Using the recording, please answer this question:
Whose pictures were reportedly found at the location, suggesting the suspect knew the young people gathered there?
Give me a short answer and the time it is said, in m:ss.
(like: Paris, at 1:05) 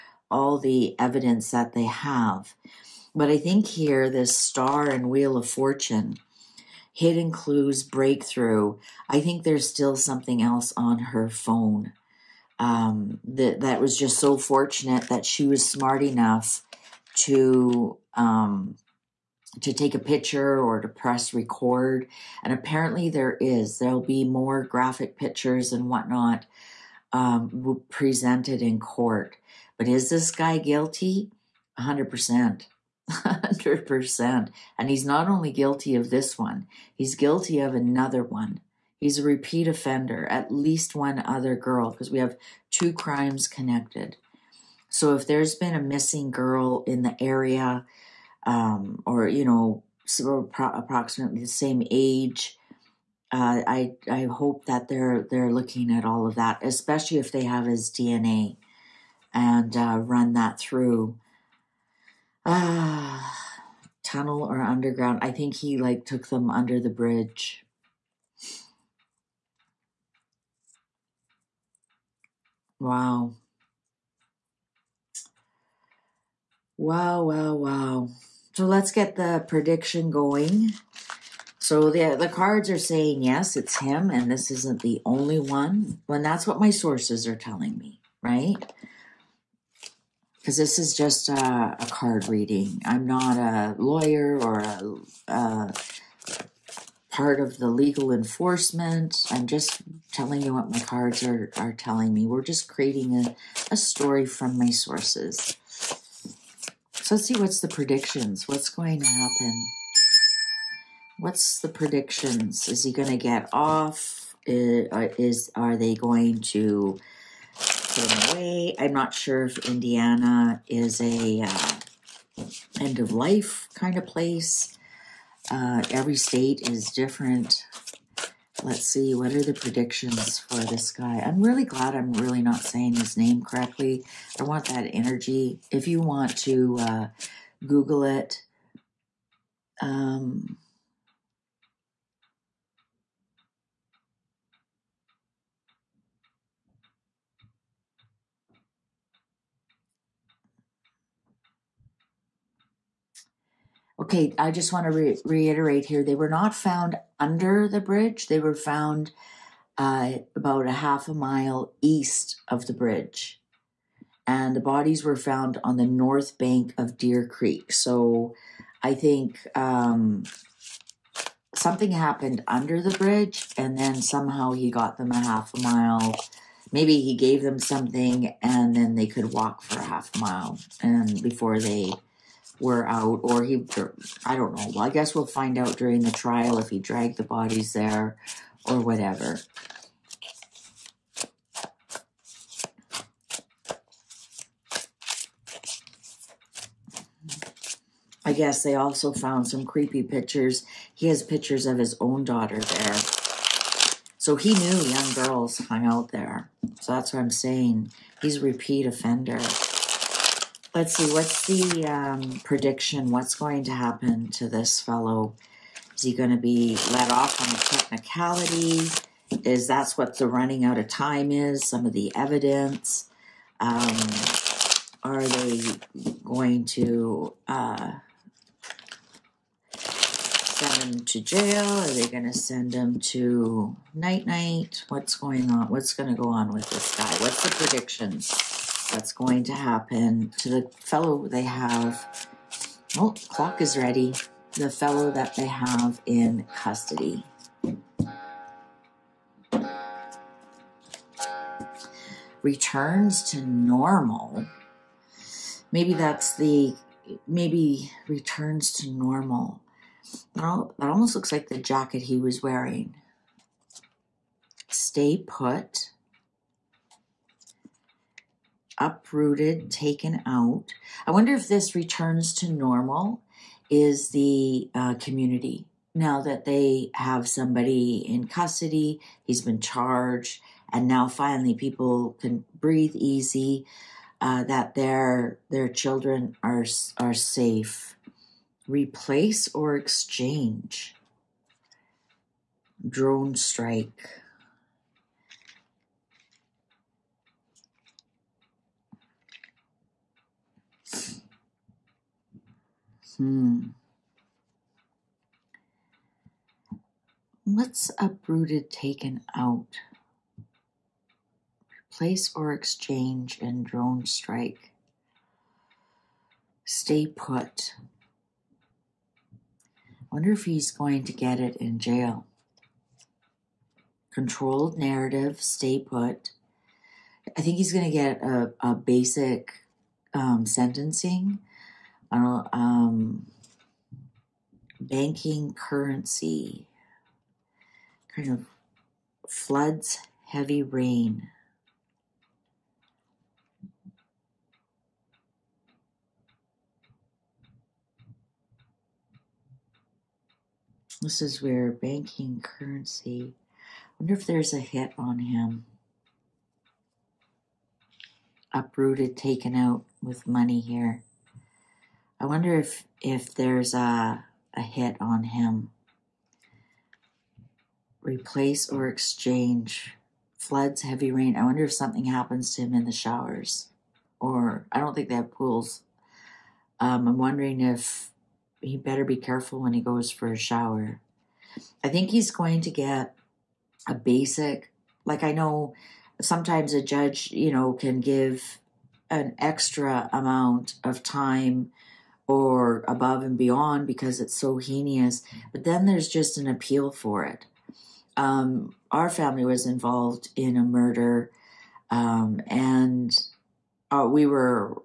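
His own daughter, at 3:21.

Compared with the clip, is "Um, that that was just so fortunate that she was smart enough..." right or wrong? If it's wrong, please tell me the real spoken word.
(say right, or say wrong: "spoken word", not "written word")
right.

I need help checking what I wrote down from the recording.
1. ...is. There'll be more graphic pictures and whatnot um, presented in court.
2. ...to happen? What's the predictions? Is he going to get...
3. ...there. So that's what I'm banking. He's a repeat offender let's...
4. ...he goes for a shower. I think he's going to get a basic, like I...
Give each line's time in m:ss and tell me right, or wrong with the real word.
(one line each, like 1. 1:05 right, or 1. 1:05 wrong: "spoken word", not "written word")
1. 0:23 right
2. 1:49 right
3. 3:26 wrong: "saying", not "banking"
4. 6:19 right.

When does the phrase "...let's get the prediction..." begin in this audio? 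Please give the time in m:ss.
1:18.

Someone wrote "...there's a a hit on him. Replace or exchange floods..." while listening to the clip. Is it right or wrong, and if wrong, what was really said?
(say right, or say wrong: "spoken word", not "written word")
right.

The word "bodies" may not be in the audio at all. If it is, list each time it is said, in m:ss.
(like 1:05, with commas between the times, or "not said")
2:44, 3:07.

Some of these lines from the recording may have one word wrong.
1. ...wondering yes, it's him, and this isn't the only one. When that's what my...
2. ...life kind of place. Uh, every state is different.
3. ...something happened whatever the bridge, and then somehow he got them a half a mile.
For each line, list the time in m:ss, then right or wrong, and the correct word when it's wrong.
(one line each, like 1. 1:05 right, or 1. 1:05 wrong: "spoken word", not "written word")
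1. 1:22 wrong: "saying", not "wondering"
2. 2:03 right
3. 2:51 wrong: "under", not "whatever".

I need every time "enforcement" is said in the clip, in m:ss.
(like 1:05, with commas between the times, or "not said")
1:38.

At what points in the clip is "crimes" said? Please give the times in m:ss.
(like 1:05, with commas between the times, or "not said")
0:42.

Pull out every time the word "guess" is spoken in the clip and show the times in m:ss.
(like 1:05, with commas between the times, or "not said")
3:04, 3:18.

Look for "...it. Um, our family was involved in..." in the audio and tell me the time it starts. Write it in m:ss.
6:37.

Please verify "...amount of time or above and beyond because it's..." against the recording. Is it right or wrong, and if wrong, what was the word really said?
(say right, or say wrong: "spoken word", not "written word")
right.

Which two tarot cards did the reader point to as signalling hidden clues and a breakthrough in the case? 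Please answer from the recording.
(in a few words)
Star and Wheel of Fortune.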